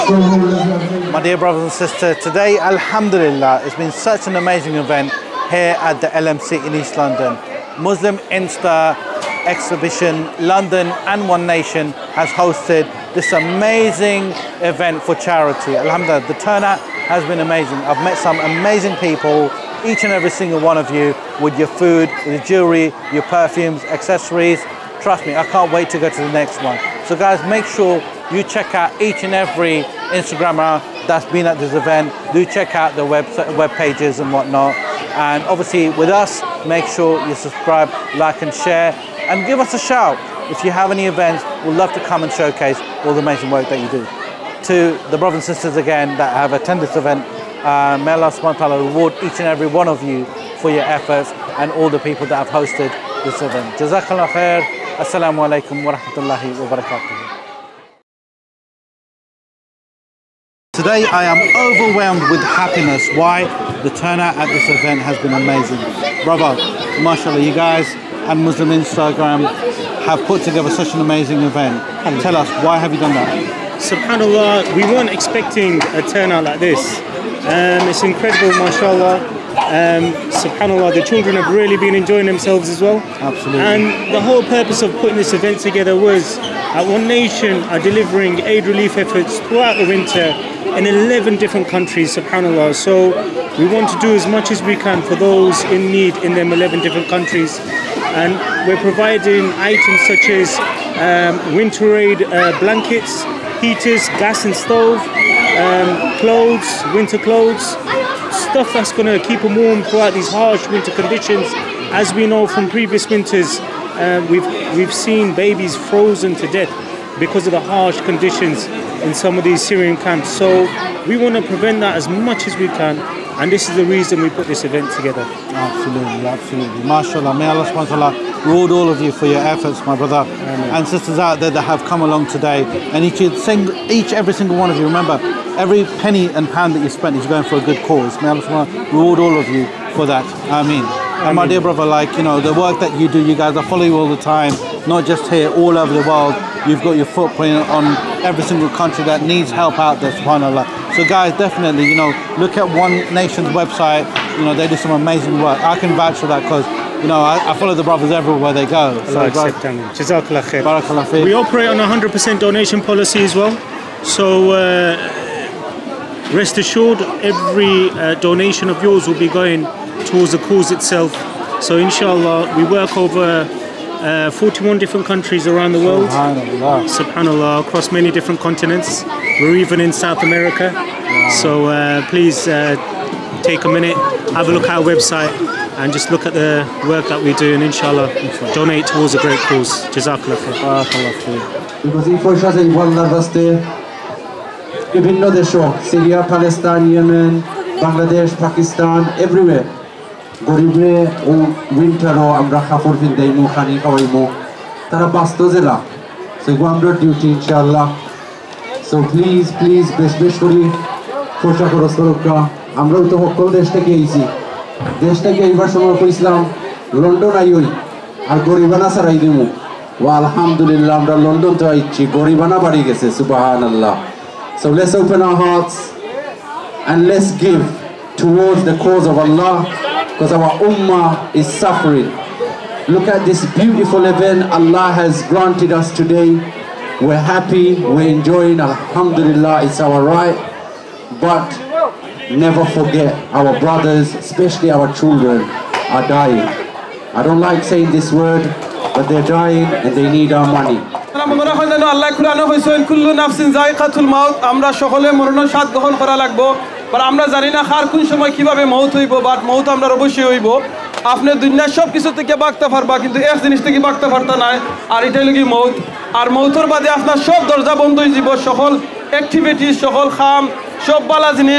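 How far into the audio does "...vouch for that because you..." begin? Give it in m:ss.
2:35.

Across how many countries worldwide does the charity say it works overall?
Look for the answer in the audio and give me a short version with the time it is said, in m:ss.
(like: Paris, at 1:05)
41, at 2:54.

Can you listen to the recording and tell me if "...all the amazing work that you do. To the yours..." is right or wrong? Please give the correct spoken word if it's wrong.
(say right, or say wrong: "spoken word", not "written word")
wrong: "brothers", not "yours".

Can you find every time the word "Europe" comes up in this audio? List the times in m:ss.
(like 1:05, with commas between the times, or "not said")
not said.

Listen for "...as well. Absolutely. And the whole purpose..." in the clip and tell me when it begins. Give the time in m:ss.
1:22.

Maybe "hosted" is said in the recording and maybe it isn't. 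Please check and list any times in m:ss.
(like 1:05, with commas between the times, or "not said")
0:12, 0:52.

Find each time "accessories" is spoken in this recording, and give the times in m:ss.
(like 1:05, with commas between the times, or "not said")
0:23.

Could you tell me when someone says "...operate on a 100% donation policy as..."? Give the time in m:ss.
2:41.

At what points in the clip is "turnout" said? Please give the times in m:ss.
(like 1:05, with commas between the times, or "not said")
0:16, 1:03, 1:16.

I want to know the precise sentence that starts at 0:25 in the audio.
Trust me, I can't wait to go to the next one.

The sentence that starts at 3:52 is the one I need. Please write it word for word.
Look at this beautiful event Allah has granted us today.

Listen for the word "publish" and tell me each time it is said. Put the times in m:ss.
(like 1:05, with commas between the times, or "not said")
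not said.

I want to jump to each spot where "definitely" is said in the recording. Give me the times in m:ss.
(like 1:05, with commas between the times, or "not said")
2:31.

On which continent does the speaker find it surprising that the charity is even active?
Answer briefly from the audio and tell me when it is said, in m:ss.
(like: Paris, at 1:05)
South America, at 2:59.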